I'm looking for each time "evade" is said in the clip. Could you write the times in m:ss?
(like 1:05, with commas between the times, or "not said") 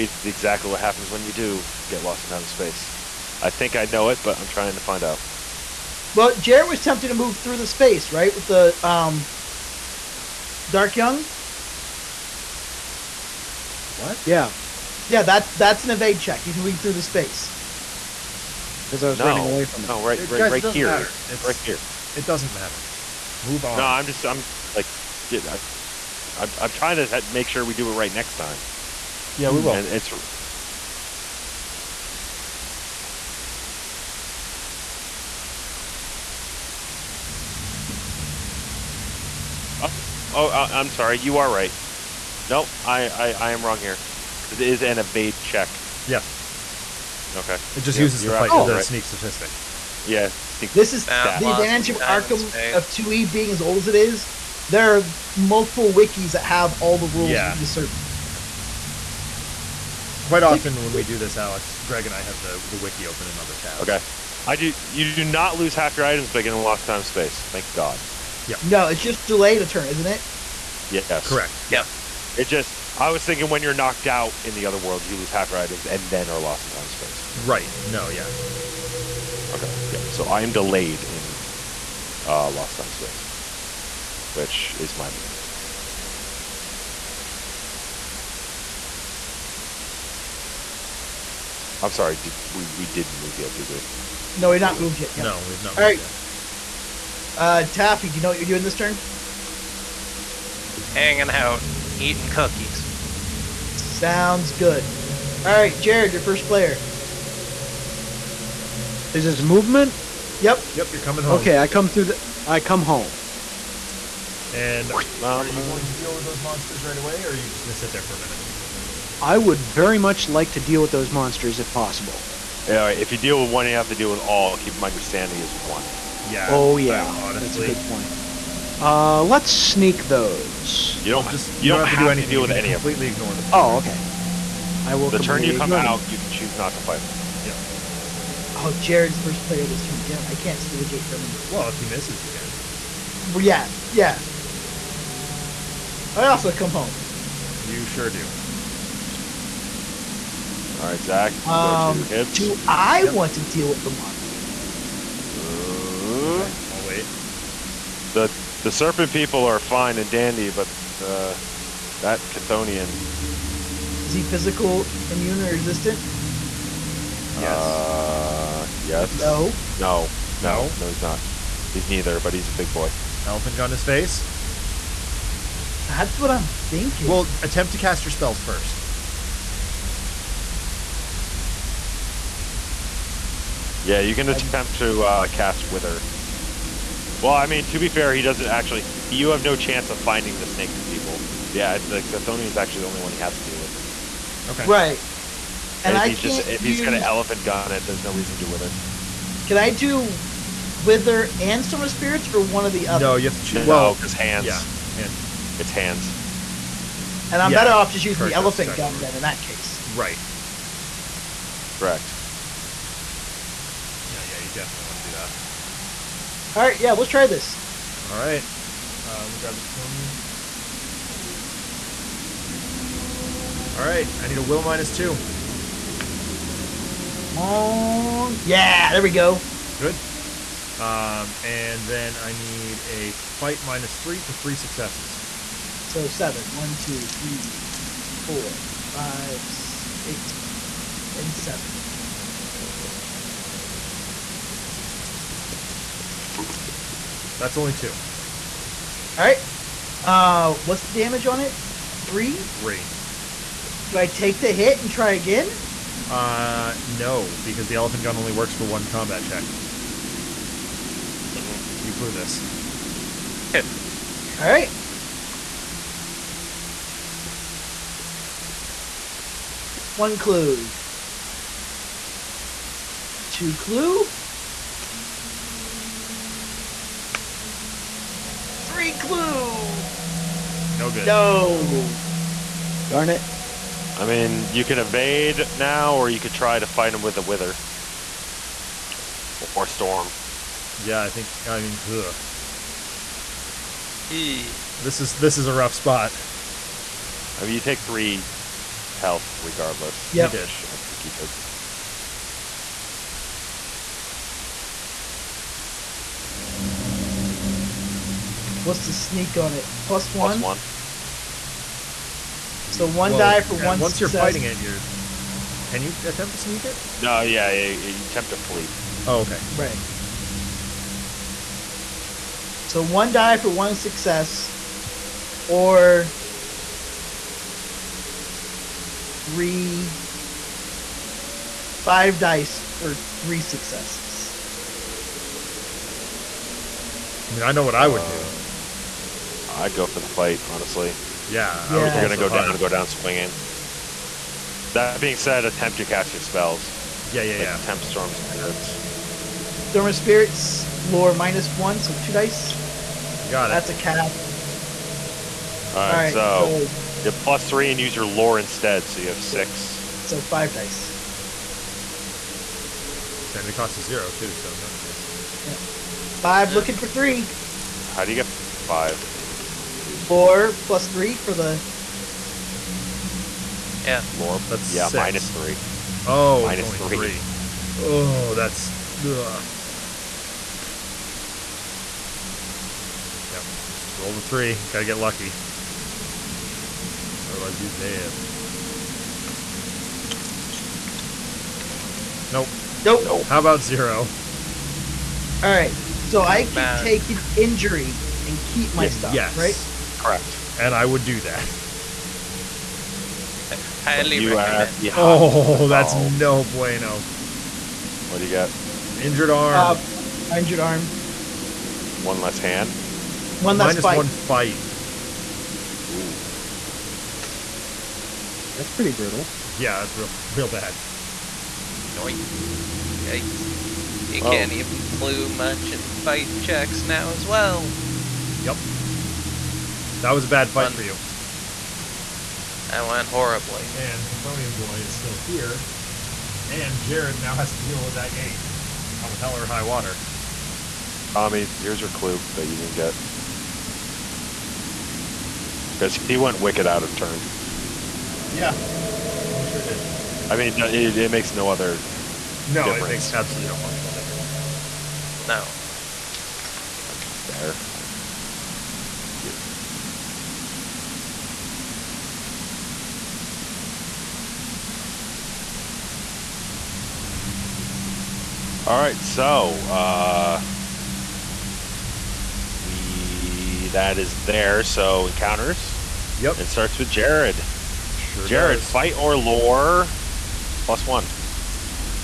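0:15, 0:44, 4:44.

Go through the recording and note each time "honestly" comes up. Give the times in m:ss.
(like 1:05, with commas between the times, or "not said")
2:07, 5:40.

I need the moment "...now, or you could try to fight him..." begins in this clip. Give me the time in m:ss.
4:45.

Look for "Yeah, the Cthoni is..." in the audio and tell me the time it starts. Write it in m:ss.
3:11.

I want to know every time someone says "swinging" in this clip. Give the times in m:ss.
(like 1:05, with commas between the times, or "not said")
5:42.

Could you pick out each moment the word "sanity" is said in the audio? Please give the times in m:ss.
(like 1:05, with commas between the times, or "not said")
2:05.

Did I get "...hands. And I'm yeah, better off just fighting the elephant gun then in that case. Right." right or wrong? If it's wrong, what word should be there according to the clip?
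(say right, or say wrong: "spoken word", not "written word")
wrong: "using", not "fighting".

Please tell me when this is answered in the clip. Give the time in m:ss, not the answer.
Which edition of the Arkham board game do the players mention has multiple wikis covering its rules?
0:52.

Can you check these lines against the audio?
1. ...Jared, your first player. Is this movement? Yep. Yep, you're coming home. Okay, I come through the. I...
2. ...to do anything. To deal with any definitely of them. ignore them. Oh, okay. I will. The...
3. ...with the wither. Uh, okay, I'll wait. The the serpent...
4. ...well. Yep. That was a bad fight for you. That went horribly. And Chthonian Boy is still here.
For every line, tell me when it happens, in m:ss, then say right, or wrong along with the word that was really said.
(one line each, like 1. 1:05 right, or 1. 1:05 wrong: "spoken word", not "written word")
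1. 1:45 right
2. 2:11 wrong: "completely", not "definitely"
3. 2:33 wrong: "monster", not "wither"
4. 7:07 right.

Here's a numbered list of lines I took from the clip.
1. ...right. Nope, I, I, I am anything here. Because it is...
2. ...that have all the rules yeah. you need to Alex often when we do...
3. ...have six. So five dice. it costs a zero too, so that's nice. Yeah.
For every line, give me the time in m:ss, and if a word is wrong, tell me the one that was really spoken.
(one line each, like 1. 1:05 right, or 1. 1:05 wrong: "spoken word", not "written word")
1. 0:41 wrong: "wrong", not "anything"
2. 0:56 wrong: "Quite", not "Alex"
3. 5:59 right.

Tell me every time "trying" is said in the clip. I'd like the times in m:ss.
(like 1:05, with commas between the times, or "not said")
0:04, 0:26.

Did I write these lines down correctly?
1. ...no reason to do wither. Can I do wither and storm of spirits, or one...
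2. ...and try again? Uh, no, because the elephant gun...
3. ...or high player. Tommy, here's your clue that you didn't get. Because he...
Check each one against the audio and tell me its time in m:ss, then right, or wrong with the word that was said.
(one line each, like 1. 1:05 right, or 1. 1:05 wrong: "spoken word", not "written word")
1. 3:18 right
2. 4:14 right
3. 7:19 wrong: "water", not "player".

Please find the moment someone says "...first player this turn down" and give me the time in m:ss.
2:19.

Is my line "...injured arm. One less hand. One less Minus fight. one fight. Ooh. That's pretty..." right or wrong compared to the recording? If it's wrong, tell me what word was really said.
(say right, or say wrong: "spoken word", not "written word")
right.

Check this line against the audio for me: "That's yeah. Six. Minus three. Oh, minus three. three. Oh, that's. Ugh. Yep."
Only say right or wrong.
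right.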